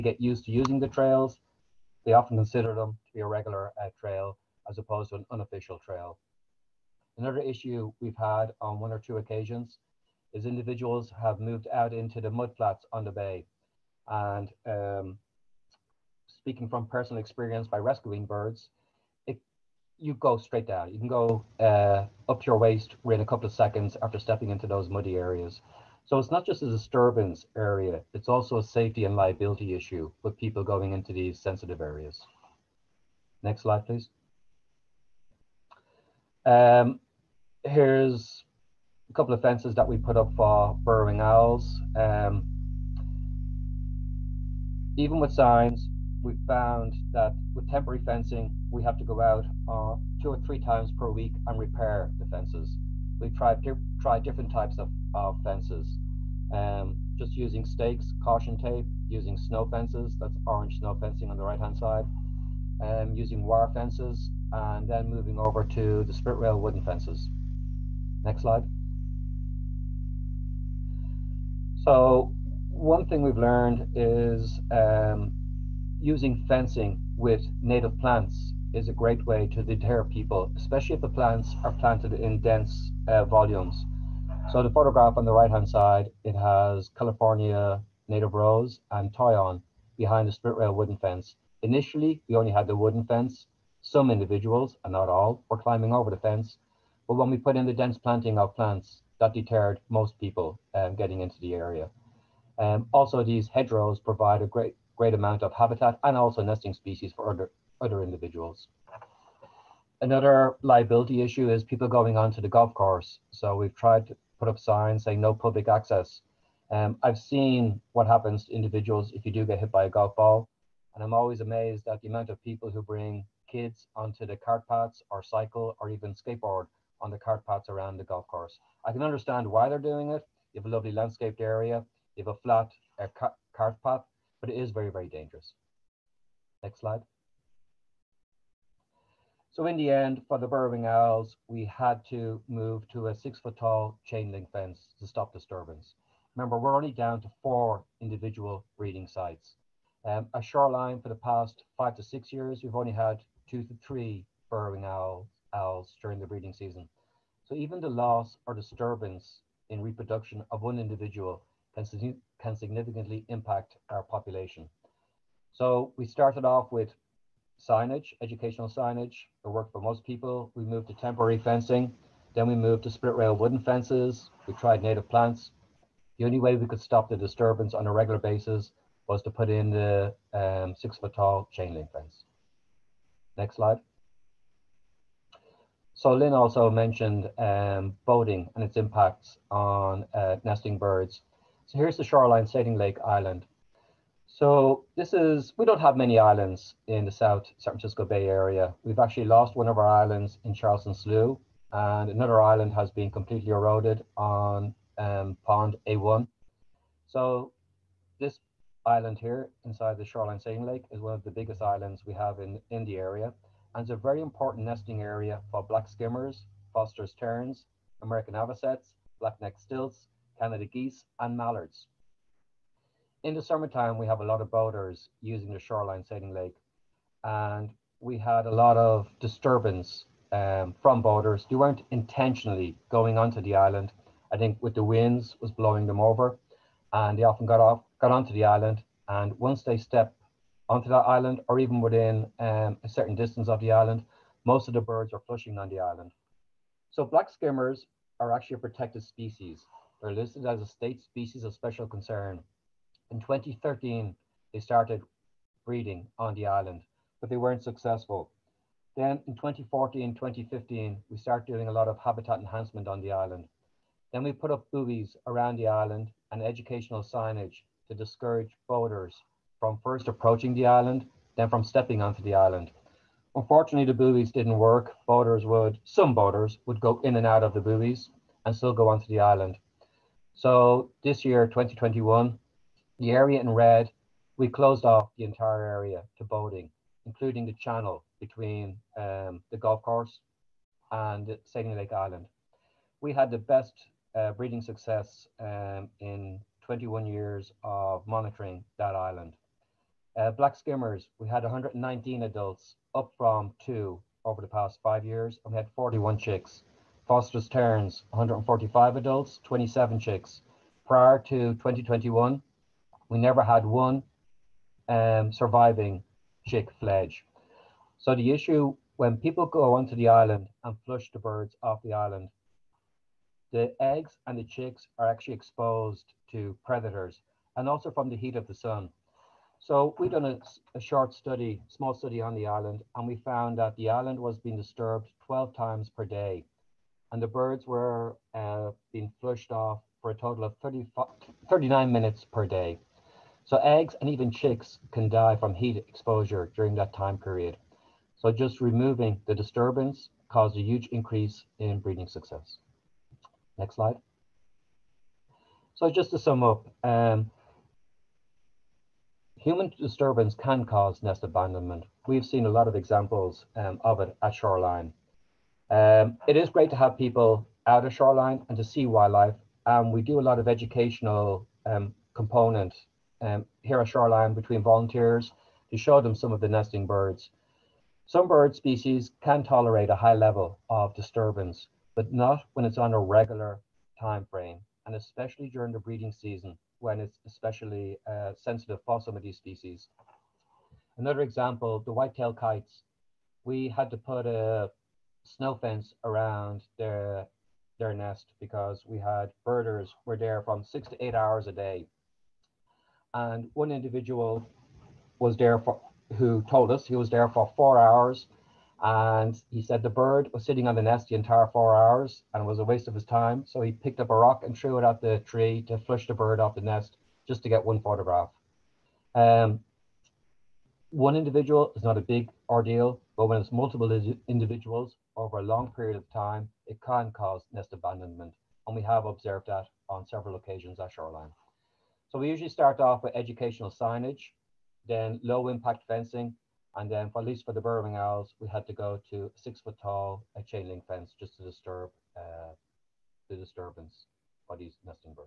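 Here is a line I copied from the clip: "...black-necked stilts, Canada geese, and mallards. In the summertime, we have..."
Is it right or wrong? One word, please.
right.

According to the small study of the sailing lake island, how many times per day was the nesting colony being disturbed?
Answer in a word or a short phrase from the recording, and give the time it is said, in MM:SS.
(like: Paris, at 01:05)
12, at 05:35.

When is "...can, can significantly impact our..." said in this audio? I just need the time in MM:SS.
02:41.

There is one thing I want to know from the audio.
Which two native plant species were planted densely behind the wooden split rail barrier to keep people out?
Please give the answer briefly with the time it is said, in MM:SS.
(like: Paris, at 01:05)
California native rose and toyon, at 01:26.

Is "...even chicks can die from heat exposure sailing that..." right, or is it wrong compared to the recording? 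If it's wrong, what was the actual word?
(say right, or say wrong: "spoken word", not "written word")
wrong: "during", not "sailing".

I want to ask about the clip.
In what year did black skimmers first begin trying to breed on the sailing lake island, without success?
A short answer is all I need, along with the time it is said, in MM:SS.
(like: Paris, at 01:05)
2013, at 04:13.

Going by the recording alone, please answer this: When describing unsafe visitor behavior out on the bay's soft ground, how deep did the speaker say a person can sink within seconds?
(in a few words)
up to your waist.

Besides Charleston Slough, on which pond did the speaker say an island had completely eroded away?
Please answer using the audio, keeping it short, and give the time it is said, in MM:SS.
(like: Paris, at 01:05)
pond A1, at 03:25.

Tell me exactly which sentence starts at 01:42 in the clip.
Um, also, these hedgerows provide a great, great amount of habitat and also nesting species for other, other individuals.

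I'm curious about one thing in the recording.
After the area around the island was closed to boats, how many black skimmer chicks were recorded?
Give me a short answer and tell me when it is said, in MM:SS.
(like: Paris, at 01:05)
41, at 05:05.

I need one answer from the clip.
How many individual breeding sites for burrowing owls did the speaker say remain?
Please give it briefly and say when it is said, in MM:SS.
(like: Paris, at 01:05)
4, at 02:27.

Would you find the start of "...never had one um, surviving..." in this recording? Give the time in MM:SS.
05:13.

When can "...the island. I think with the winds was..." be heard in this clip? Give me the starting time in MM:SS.
03:53.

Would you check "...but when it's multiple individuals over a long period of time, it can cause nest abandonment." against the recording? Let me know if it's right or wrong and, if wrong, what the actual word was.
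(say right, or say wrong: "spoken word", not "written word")
right.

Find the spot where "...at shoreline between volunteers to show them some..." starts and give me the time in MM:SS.
06:13.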